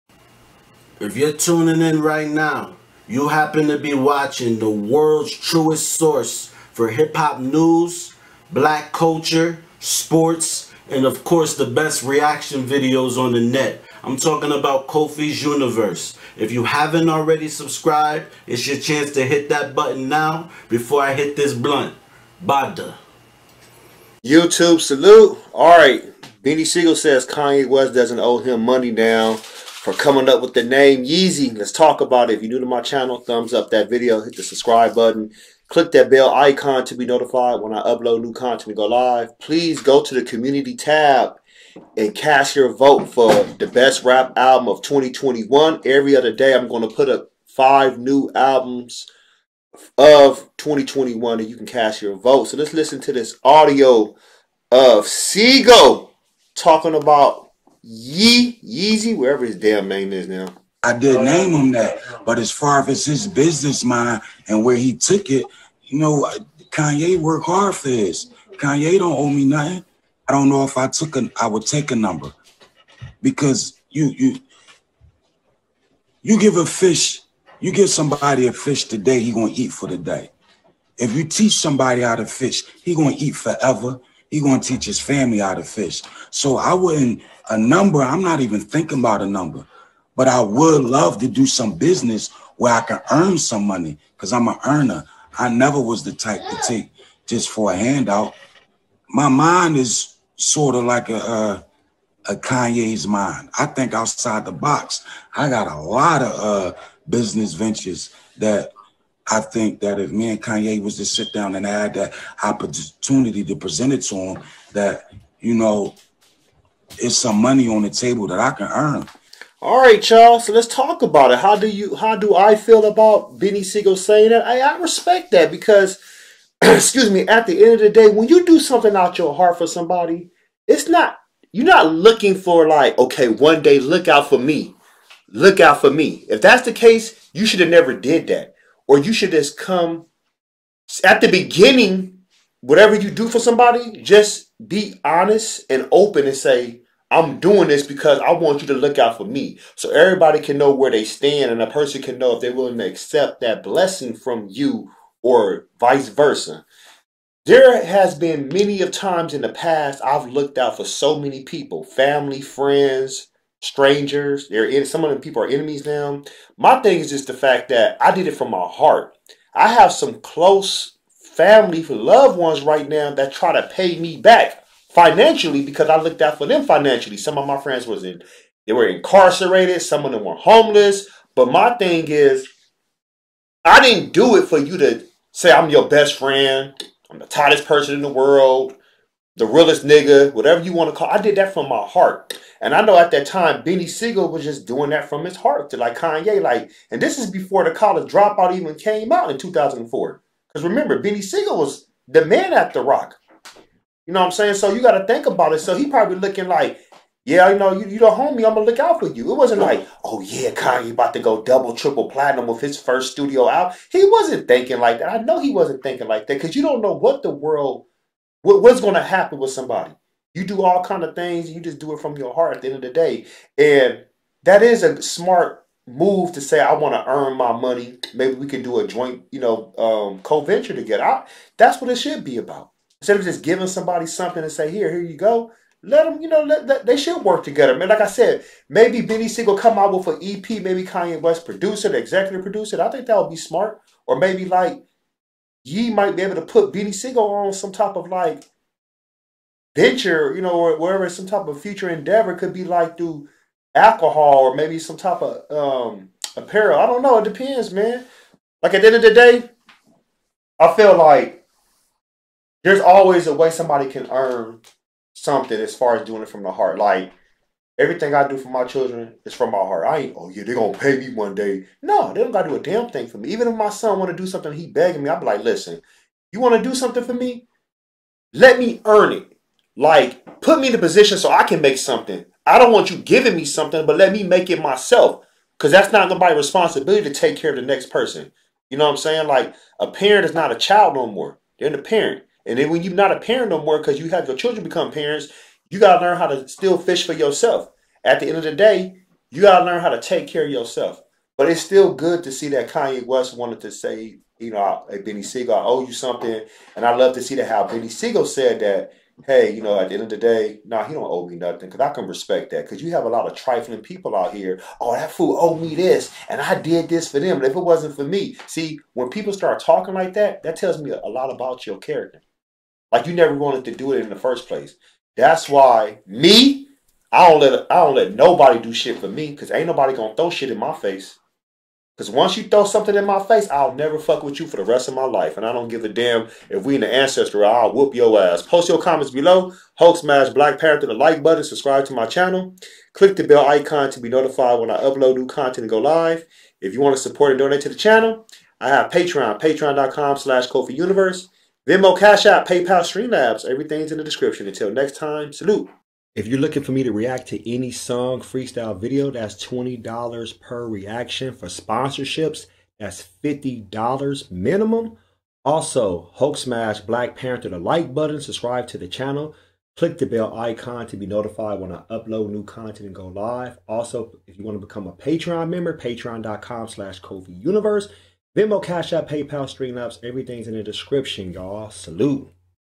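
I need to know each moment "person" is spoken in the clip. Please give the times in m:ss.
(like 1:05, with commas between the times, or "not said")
2:31, 3:07, 4:47.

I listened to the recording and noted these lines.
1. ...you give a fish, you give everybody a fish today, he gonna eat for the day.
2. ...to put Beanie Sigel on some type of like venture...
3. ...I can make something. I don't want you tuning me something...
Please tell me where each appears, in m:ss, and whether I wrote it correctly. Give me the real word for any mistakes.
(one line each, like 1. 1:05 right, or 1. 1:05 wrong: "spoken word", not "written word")
1. 1:16 wrong: "somebody", not "everybody"
2. 4:06 right
3. 4:41 wrong: "giving", not "tuning".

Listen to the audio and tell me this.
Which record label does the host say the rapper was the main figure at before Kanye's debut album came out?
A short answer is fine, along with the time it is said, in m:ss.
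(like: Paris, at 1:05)
The Roc, at 3:22.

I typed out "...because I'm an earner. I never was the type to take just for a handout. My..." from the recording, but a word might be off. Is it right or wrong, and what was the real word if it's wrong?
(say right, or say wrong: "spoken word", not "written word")
right.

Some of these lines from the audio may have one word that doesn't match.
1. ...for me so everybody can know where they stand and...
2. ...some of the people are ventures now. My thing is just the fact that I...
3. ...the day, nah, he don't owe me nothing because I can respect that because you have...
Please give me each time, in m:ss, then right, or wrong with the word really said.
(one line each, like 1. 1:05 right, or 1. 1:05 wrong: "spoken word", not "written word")
1. 2:29 right
2. 2:44 wrong: "enemies", not "ventures"
3. 5:10 right.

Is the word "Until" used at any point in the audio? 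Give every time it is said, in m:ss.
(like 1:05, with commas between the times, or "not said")
5:54.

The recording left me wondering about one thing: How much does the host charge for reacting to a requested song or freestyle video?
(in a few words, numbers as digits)
$20.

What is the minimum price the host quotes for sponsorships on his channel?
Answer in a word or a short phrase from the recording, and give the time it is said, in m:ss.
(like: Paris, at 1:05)
$50, at 6:03.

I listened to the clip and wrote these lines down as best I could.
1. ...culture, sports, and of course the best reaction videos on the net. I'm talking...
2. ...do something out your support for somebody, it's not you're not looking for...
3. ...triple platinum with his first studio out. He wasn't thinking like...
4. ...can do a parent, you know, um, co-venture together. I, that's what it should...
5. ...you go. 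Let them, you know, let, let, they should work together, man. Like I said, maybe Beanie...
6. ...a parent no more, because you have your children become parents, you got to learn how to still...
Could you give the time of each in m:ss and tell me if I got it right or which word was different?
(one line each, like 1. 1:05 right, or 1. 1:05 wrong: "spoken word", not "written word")
1. 0:08 right
2. 2:08 wrong: "heart", not "support"
3. 3:31 right
4. 3:48 wrong: "joint", not "parent"
5. 3:55 right
6. 4:53 right.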